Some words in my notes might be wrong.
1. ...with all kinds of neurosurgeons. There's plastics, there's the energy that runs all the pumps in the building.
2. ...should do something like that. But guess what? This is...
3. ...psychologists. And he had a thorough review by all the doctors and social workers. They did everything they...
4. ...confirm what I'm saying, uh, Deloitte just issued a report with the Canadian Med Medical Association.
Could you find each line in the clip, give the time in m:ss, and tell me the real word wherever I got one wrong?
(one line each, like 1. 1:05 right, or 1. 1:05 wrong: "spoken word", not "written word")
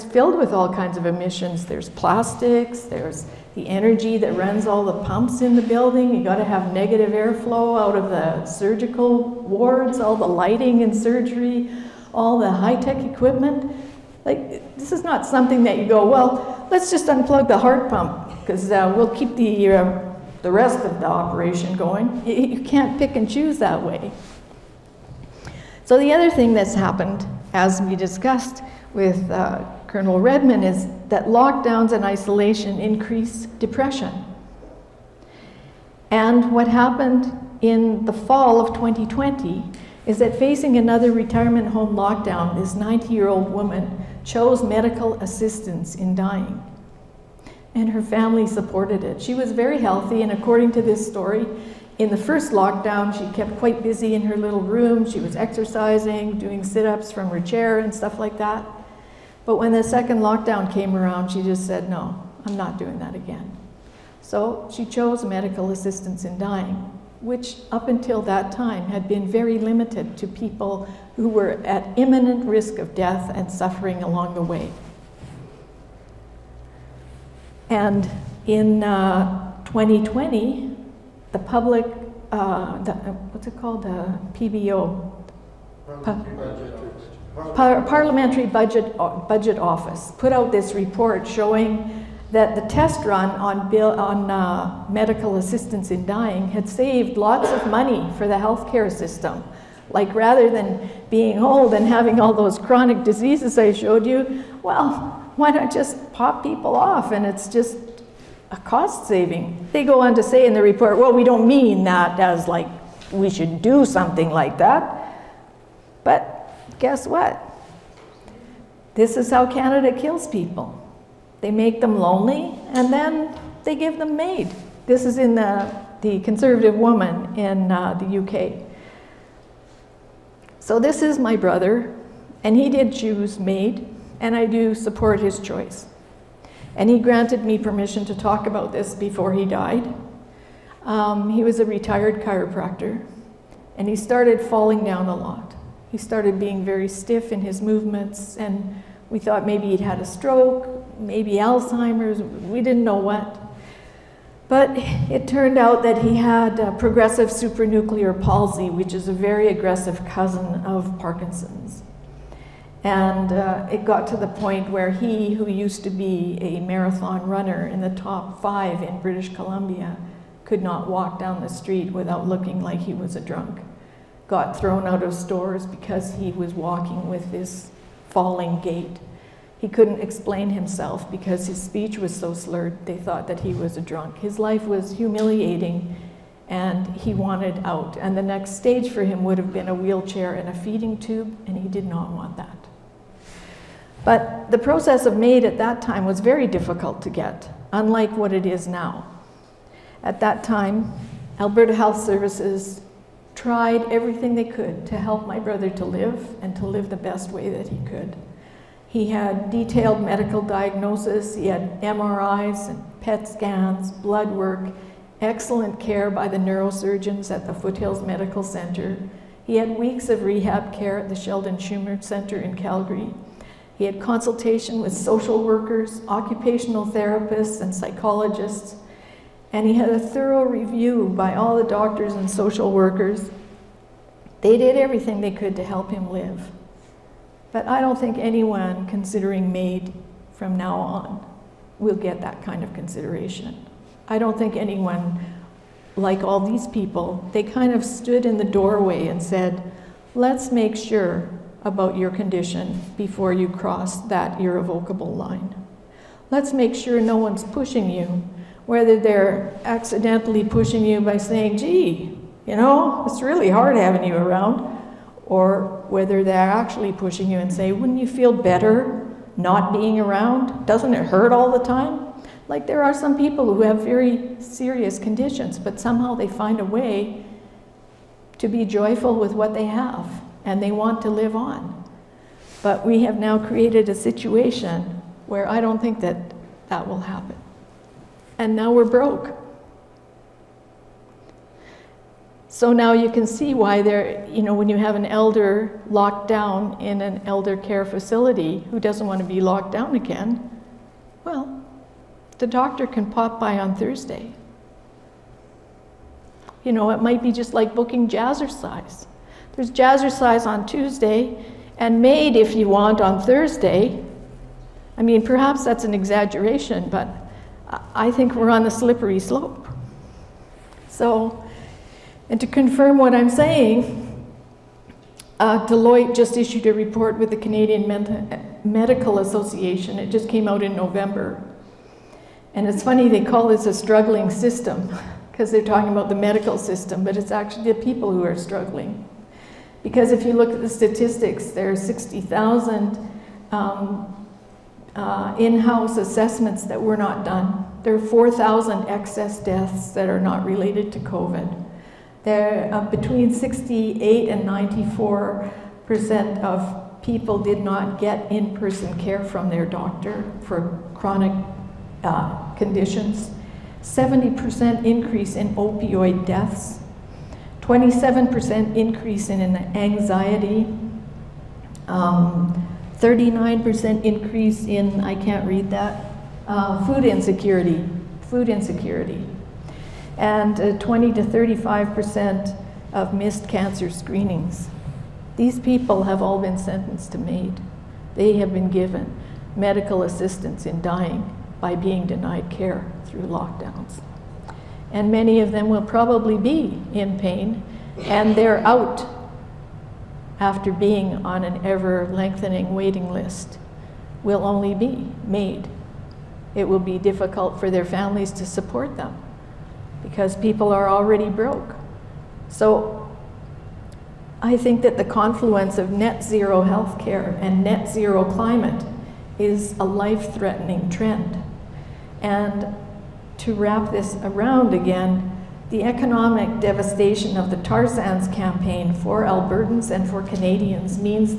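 1. 0:00 wrong: "emissions", not "neurosurgeons"
2. 1:53 right
3. 3:47 right
4. 5:22 right.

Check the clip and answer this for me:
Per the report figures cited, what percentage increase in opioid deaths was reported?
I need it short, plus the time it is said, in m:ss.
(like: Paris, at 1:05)
70%, at 6:03.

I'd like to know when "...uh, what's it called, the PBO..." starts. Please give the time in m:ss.
1:22.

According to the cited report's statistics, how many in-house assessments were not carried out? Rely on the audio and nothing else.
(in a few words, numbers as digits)
60,000.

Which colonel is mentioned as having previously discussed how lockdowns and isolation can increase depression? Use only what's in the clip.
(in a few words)
Colonel Redman.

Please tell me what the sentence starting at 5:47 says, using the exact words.
There are 4,000 excess deaths that are not related to COVID.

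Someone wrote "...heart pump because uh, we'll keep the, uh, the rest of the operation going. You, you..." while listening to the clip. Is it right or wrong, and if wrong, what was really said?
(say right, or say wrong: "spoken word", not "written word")
right.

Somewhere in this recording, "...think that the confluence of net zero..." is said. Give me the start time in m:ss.
6:54.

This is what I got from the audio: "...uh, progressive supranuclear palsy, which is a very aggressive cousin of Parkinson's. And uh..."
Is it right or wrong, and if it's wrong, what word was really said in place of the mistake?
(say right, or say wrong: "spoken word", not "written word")
right.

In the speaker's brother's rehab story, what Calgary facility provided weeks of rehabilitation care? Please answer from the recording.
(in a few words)
Sheldon Chumir Center.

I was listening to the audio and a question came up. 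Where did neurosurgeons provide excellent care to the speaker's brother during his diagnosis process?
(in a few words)
Foothills Medical Center.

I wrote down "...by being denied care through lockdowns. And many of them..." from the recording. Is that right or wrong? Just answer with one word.
right.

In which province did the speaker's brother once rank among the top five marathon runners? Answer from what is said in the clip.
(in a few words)
British Columbia.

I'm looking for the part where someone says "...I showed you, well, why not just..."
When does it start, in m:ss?
1:43.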